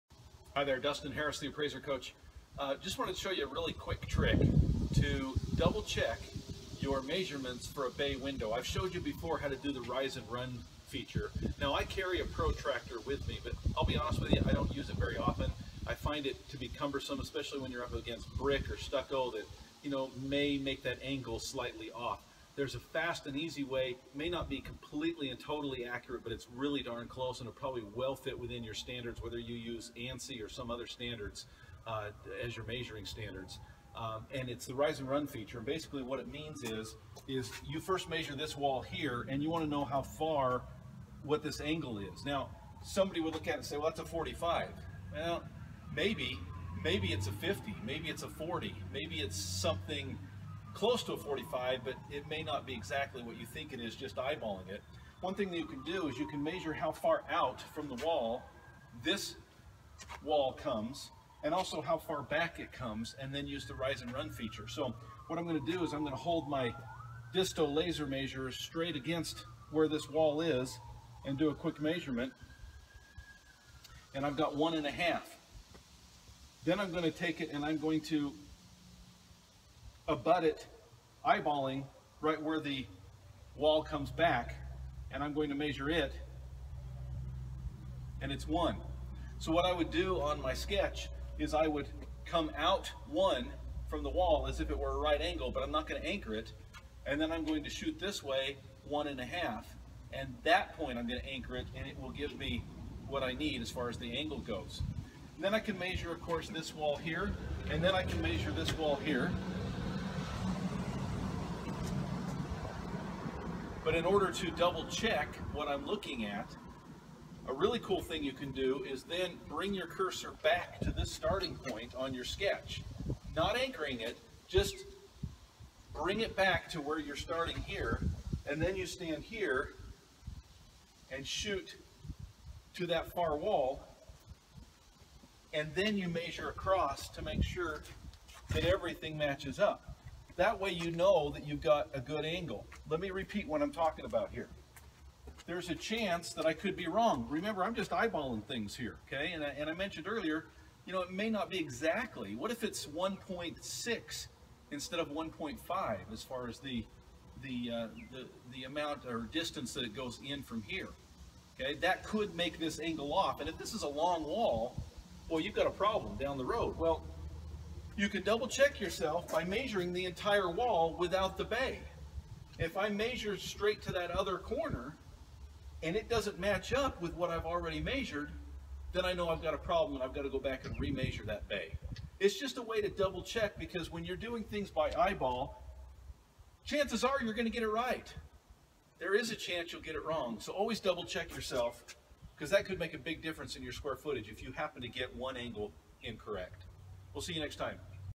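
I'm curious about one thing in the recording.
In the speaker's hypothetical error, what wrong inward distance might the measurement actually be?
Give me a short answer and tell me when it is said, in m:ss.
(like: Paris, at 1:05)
1.6, at 2:32.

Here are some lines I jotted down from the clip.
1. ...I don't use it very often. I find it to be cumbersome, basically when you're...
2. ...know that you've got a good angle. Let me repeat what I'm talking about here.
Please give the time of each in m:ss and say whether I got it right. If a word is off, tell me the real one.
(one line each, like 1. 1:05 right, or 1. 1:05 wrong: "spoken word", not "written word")
1. 0:14 wrong: "especially", not "basically"
2. 2:20 right.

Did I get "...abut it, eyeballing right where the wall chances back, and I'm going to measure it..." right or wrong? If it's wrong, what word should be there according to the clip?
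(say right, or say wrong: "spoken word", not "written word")
wrong: "comes", not "chances".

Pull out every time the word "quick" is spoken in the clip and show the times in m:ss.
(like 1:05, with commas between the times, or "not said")
0:03, 1:11.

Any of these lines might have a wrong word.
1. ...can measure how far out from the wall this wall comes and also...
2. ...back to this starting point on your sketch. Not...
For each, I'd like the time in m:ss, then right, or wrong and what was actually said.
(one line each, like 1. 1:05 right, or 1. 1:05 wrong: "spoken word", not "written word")
1. 0:56 right
2. 2:00 right.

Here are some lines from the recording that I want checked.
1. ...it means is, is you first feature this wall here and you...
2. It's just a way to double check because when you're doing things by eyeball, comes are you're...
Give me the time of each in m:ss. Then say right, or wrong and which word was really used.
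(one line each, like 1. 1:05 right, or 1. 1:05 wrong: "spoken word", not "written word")
1. 0:36 wrong: "measure", not "feature"
2. 3:02 wrong: "chances", not "comes".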